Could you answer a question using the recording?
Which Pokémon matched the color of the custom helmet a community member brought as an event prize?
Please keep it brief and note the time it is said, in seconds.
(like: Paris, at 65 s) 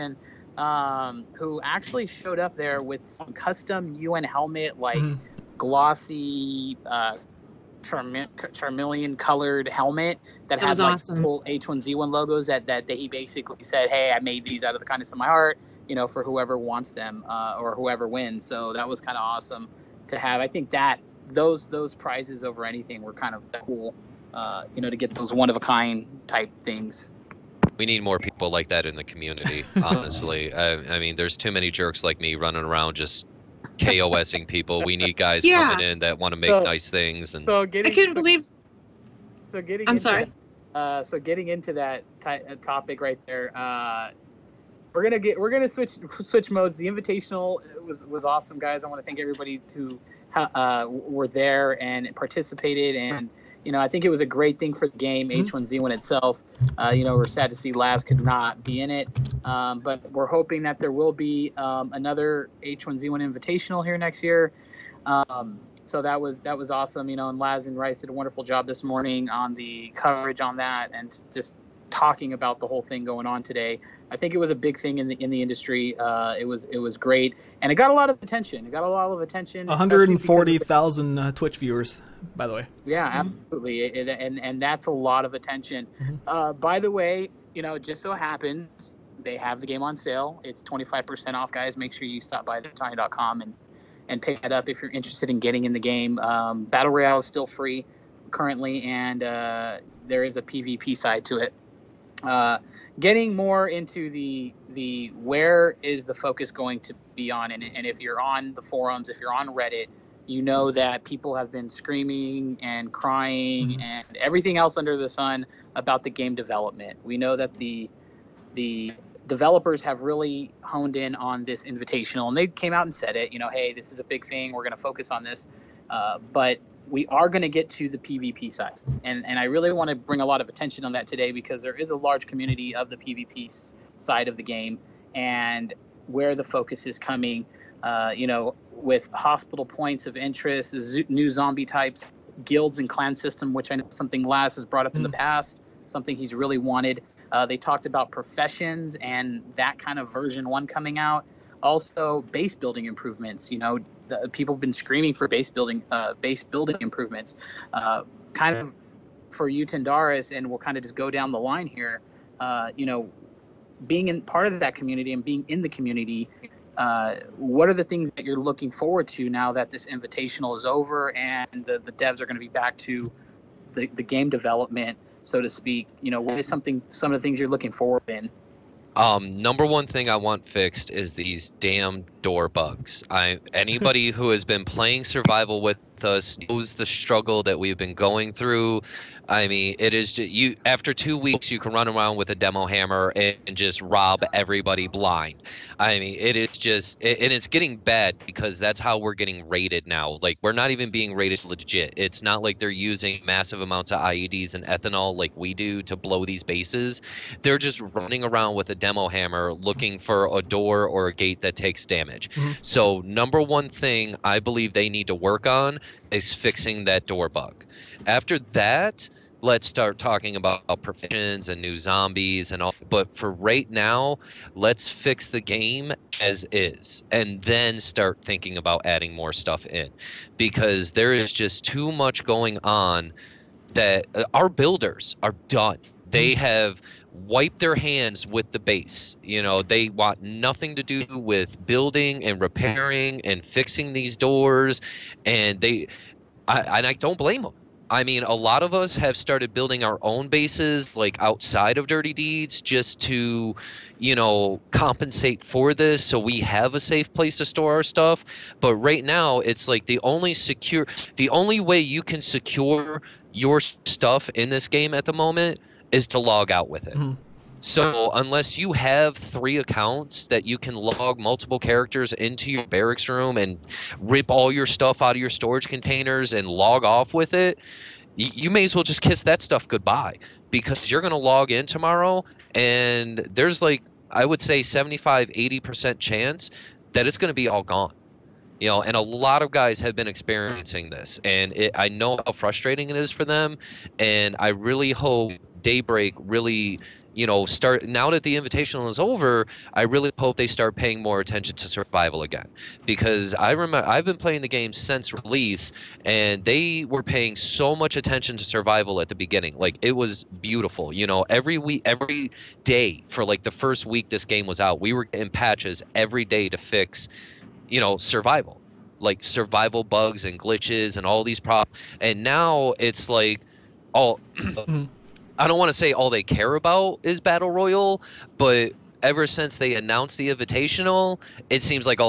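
Charmeleon, at 8 s.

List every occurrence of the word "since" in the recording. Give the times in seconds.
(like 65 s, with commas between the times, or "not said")
304 s, 329 s.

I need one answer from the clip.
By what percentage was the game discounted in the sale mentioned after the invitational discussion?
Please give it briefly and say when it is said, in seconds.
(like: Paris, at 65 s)
25%, at 90 s.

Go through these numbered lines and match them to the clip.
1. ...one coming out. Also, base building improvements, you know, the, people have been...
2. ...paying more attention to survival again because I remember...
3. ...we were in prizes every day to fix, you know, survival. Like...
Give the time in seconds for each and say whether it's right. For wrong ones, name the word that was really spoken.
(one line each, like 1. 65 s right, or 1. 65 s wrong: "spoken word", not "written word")
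1. 150 s right
2. 300 s right
3. 314 s wrong: "patches", not "prizes".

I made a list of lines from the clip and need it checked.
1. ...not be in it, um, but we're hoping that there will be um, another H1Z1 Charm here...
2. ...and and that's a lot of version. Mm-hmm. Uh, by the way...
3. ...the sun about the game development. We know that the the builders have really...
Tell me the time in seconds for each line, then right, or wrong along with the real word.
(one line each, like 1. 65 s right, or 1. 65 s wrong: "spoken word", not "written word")
1. 58 s wrong: "Invitational", not "Charm"
2. 84 s wrong: "attention", not "version"
3. 114 s wrong: "developers", not "builders".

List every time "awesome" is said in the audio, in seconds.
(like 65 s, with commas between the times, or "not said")
10 s, 19 s, 48 s, 66 s.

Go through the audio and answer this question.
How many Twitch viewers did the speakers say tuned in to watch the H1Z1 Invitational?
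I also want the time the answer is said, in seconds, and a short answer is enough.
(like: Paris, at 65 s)
140,000, at 79 s.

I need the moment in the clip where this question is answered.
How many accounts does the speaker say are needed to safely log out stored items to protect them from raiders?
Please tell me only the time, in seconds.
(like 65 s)
269 s.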